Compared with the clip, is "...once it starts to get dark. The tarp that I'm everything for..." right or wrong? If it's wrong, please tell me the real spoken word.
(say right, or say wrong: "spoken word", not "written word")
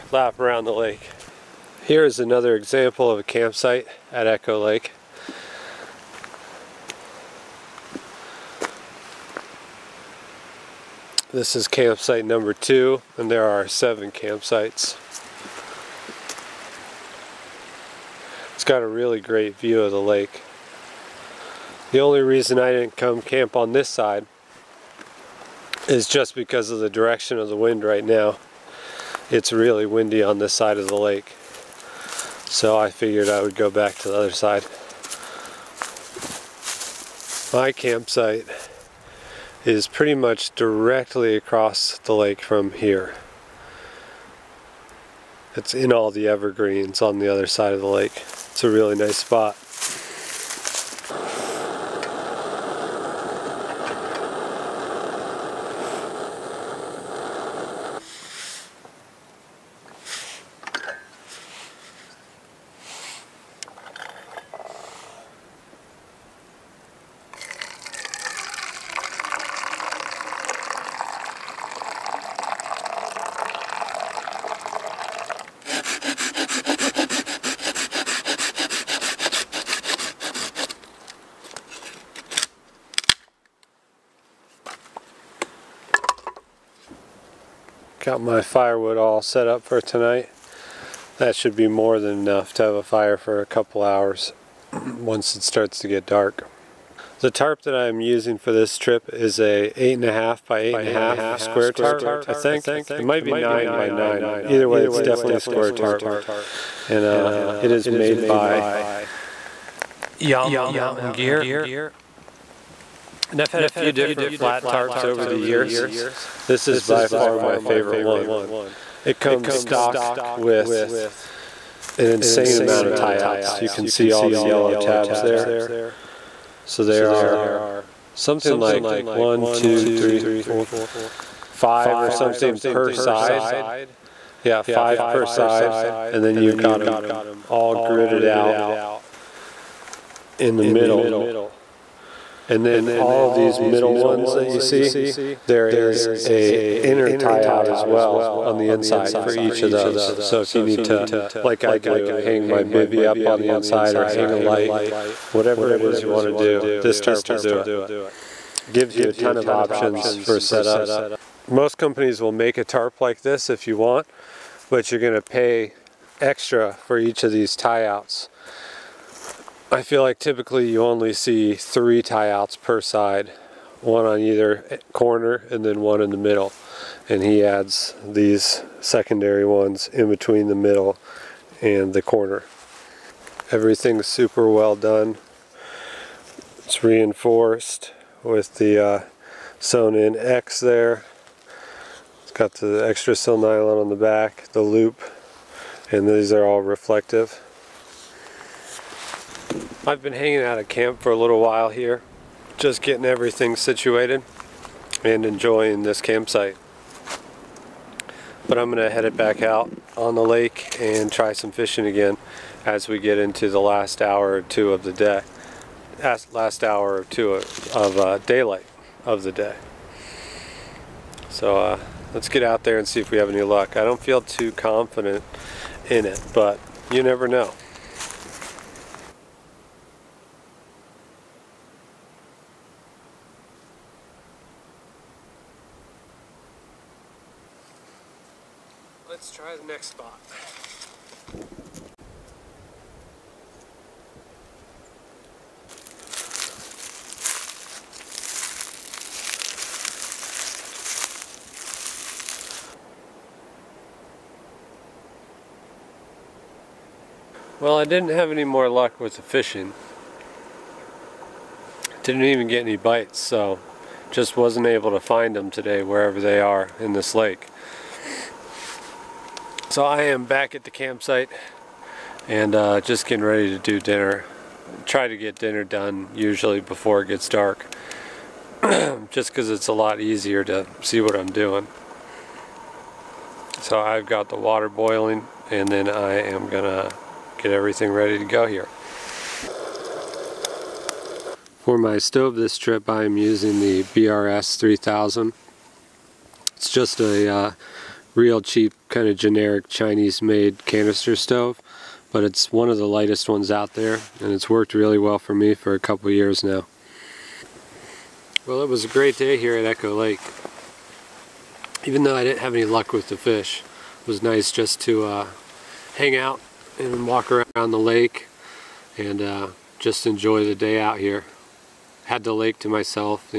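wrong: "using", not "everything".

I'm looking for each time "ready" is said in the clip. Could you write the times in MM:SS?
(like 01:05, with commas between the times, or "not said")
04:33, 04:47.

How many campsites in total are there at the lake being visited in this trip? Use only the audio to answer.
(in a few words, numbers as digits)
7.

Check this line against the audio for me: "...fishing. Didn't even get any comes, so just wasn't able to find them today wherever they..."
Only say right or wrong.
wrong.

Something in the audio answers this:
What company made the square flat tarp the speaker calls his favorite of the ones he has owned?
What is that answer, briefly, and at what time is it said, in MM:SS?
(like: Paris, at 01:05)
Yama Mountain Gear, at 01:50.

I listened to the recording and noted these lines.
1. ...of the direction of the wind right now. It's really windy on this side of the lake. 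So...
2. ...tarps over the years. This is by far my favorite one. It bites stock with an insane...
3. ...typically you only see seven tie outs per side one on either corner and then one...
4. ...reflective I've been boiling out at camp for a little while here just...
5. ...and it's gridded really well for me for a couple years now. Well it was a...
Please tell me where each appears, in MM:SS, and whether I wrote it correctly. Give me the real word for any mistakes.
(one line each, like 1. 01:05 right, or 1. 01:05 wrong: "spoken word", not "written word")
1. 00:26 right
2. 01:54 wrong: "comes", not "bites"
3. 02:50 wrong: "three", not "seven"
4. 03:16 wrong: "hanging", not "boiling"
5. 05:04 wrong: "worked", not "gridded".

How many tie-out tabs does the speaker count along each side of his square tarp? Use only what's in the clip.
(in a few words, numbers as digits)
5.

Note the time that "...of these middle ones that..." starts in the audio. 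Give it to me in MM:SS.
02:23.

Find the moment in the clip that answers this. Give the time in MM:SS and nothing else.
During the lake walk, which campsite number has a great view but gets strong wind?
00:11.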